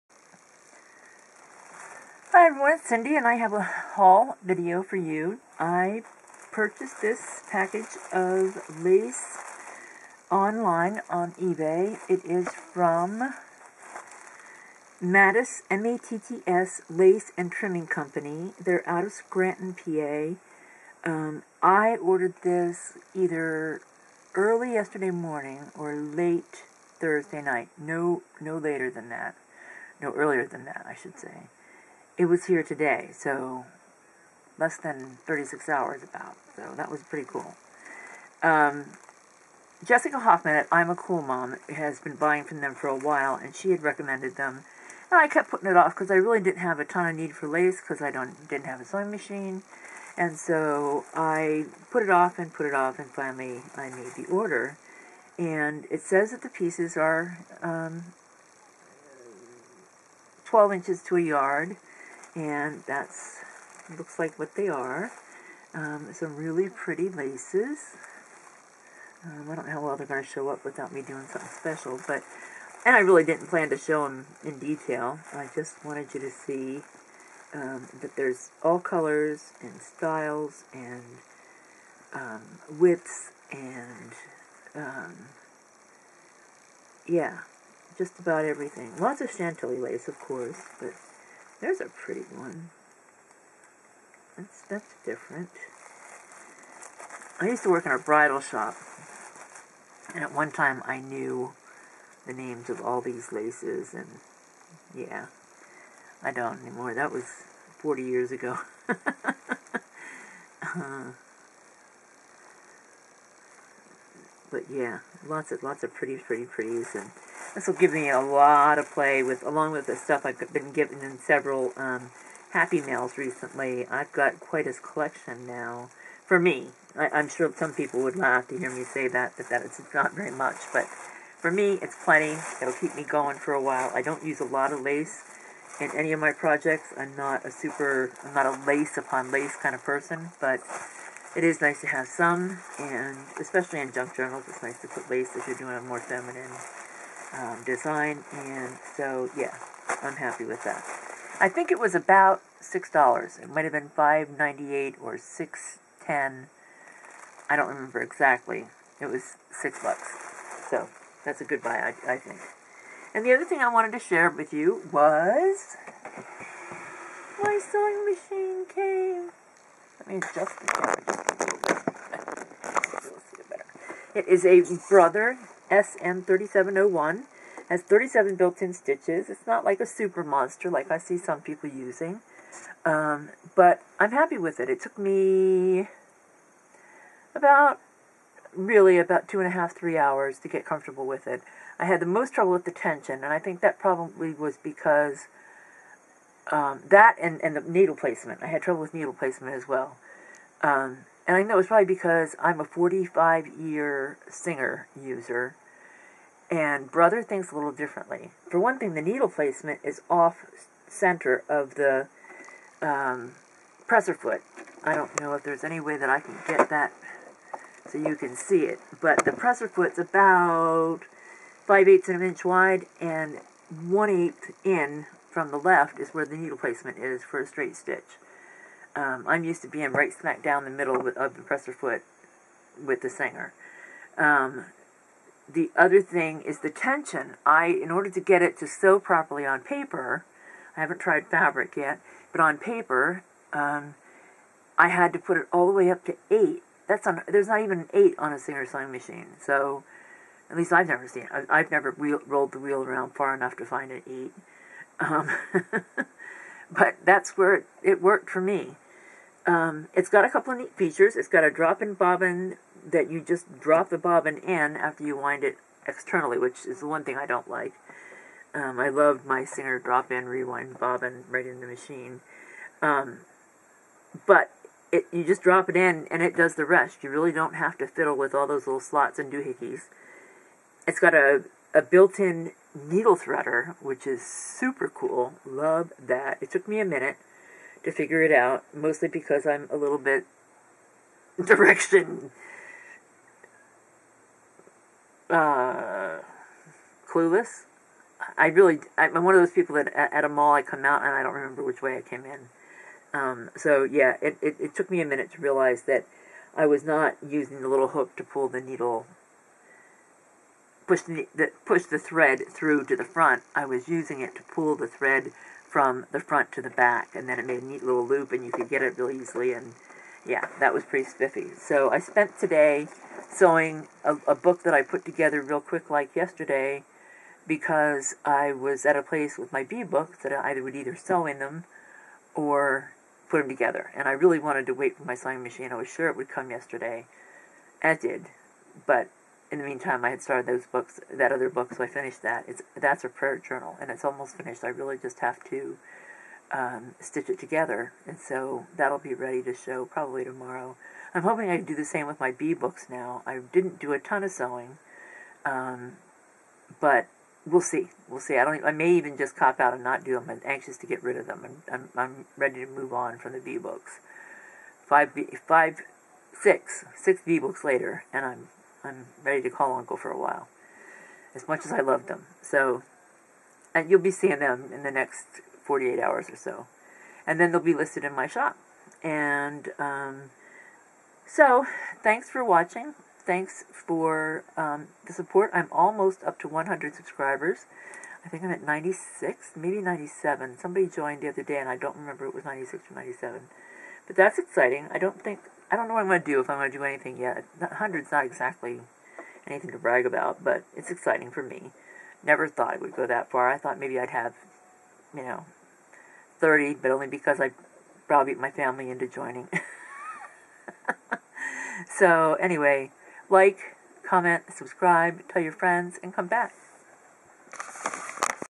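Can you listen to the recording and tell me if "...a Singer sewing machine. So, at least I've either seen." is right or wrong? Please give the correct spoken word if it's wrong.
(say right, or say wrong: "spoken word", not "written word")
wrong: "never", not "either".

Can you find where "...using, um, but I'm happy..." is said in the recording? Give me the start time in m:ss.
3:01.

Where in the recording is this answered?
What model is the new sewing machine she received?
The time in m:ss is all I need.
2:54.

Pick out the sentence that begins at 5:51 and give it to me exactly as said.
I'm hoping I do the same with my bee books now.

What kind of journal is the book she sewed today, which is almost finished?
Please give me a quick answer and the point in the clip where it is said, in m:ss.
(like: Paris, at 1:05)
prayer journal, at 5:43.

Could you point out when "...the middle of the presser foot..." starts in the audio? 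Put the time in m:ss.
3:50.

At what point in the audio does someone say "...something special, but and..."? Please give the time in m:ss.
1:11.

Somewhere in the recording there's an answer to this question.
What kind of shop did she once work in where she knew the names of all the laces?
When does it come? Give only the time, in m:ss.
1:37.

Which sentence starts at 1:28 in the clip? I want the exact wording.
Lots of chantilly lace, of course, but there's a pretty one.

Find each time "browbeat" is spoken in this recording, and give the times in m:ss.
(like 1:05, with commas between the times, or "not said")
6:48.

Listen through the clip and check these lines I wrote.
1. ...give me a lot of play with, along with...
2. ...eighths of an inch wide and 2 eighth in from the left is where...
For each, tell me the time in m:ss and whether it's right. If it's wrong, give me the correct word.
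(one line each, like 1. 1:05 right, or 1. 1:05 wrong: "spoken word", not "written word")
1. 1:57 right
2. 3:41 wrong: "1", not "2".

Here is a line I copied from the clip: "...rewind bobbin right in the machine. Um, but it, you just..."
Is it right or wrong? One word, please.
right.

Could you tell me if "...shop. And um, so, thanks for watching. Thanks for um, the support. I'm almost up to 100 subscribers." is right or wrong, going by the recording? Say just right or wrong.
right.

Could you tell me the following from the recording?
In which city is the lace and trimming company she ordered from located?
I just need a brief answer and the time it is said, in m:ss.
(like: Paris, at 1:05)
Scranton, PA, at 0:19.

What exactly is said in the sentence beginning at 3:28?
For one thing, the needle placement is off center of the um, presser foot.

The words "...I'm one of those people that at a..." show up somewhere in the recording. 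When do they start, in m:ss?
4:58.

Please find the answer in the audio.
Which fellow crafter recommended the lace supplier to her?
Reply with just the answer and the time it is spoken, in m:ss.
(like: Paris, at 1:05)
Jessica Hoffman, at 0:39.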